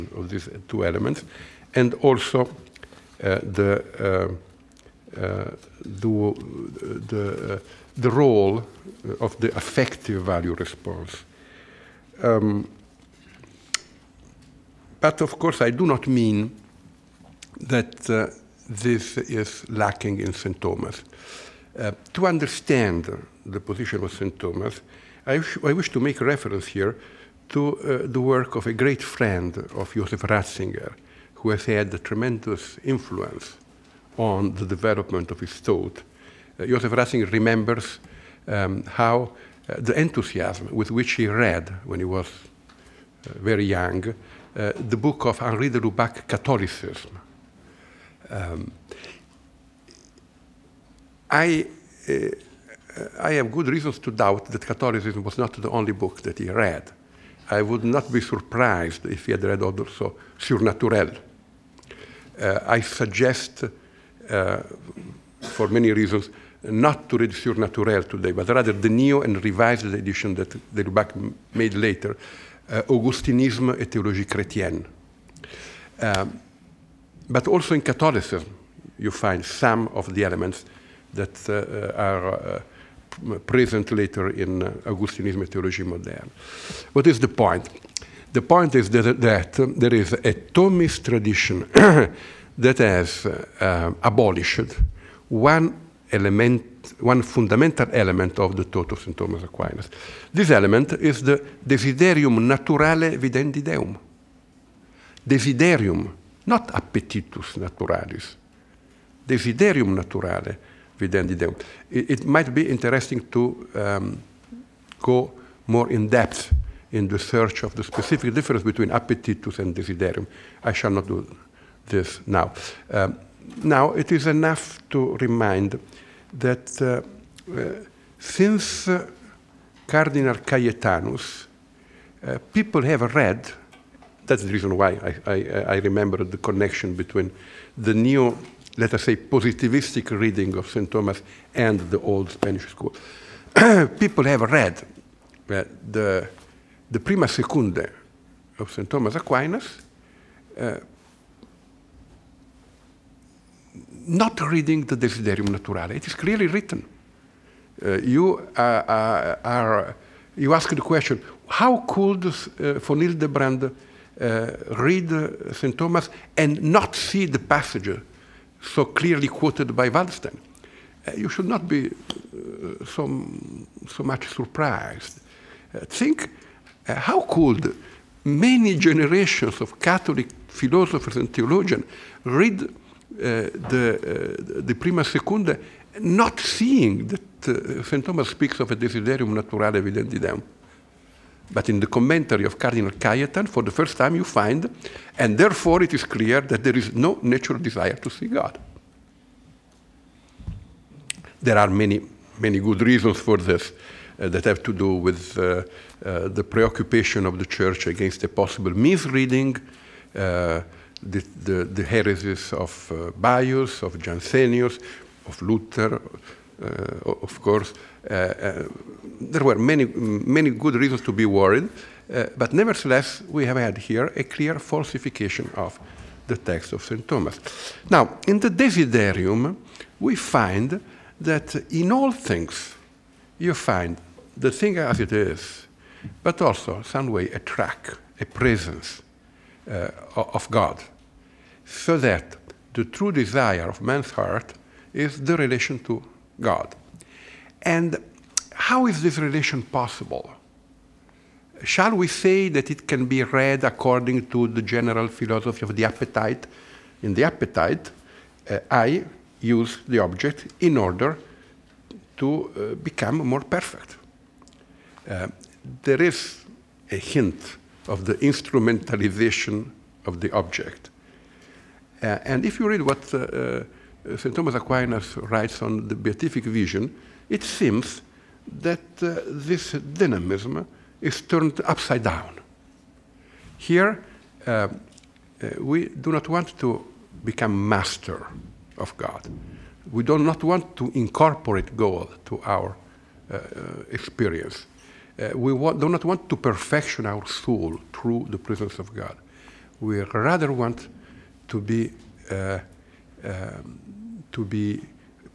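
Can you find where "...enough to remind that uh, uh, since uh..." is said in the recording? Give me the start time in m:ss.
2:04.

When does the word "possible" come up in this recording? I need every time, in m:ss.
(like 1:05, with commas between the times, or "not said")
3:28, 4:09.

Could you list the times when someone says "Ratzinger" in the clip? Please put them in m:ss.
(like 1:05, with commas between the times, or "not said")
0:30, 0:36.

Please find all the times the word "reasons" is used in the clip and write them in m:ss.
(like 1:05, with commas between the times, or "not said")
0:53, 1:05, 2:14, 3:22, 3:40.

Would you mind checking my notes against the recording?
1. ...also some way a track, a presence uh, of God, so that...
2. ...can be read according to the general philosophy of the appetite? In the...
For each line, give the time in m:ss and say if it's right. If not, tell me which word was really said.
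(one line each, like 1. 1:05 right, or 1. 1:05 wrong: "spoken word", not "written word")
1. 3:56 right
2. 4:12 right.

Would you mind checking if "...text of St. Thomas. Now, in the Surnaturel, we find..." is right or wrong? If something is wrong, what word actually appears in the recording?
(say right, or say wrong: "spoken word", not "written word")
wrong: "Desiderium", not "Surnaturel".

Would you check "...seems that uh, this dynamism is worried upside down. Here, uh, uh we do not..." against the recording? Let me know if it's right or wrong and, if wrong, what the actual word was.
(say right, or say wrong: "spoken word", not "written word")
wrong: "turned", not "worried".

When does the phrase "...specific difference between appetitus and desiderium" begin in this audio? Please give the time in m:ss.
1:57.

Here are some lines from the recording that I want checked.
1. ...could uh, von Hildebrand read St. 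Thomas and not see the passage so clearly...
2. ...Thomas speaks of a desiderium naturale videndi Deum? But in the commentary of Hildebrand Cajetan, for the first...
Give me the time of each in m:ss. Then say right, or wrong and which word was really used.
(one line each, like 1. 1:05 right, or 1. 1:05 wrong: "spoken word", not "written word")
1. 2:41 right
2. 3:08 wrong: "Cardinal", not "Hildebrand".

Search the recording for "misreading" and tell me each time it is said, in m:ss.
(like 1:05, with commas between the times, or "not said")
3:28.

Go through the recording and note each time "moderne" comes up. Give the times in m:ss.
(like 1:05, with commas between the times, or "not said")
1:25.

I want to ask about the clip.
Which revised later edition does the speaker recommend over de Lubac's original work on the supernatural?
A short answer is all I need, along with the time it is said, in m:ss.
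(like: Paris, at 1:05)
Augustinisme et théologie chrétienne, at 1:12.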